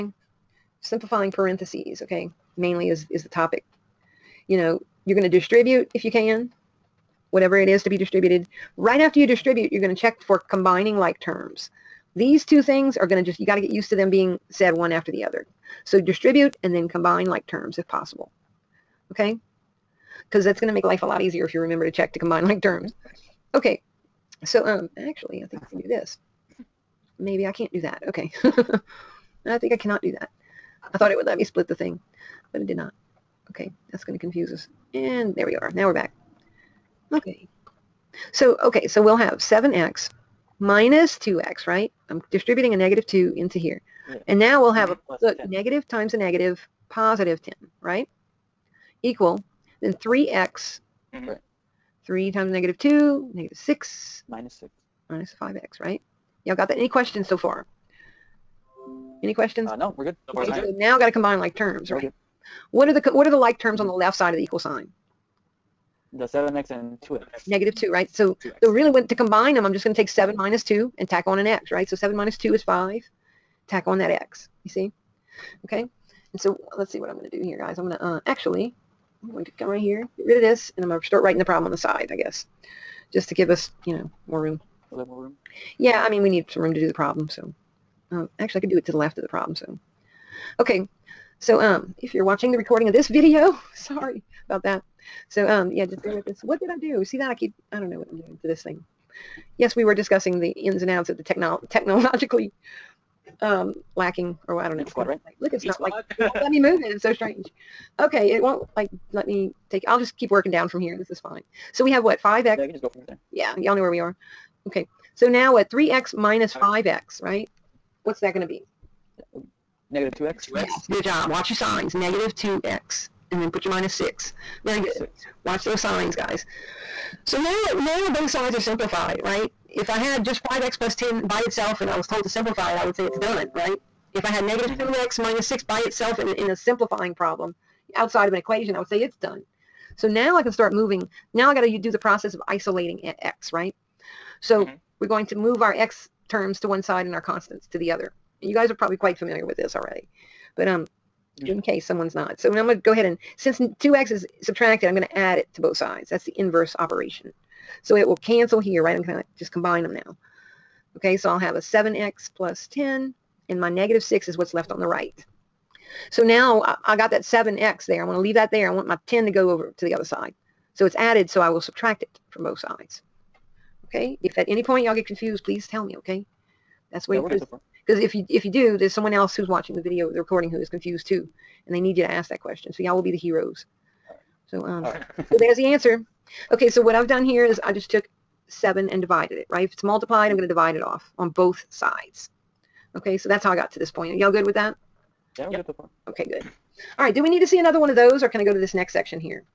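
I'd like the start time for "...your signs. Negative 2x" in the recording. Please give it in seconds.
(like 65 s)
121 s.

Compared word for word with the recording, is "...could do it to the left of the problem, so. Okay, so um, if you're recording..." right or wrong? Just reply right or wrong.
wrong.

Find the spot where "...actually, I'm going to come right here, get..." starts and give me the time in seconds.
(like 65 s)
78 s.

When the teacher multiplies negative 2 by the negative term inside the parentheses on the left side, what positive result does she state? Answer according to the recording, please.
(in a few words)
10.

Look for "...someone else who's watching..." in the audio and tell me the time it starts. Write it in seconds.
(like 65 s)
178 s.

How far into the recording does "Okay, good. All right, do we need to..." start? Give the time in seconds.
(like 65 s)
196 s.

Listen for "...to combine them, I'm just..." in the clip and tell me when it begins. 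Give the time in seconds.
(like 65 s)
69 s.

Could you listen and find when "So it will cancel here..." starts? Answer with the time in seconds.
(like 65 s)
157 s.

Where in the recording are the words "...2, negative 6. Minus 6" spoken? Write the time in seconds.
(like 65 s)
52 s.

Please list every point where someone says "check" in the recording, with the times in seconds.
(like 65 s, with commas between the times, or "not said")
9 s, 21 s.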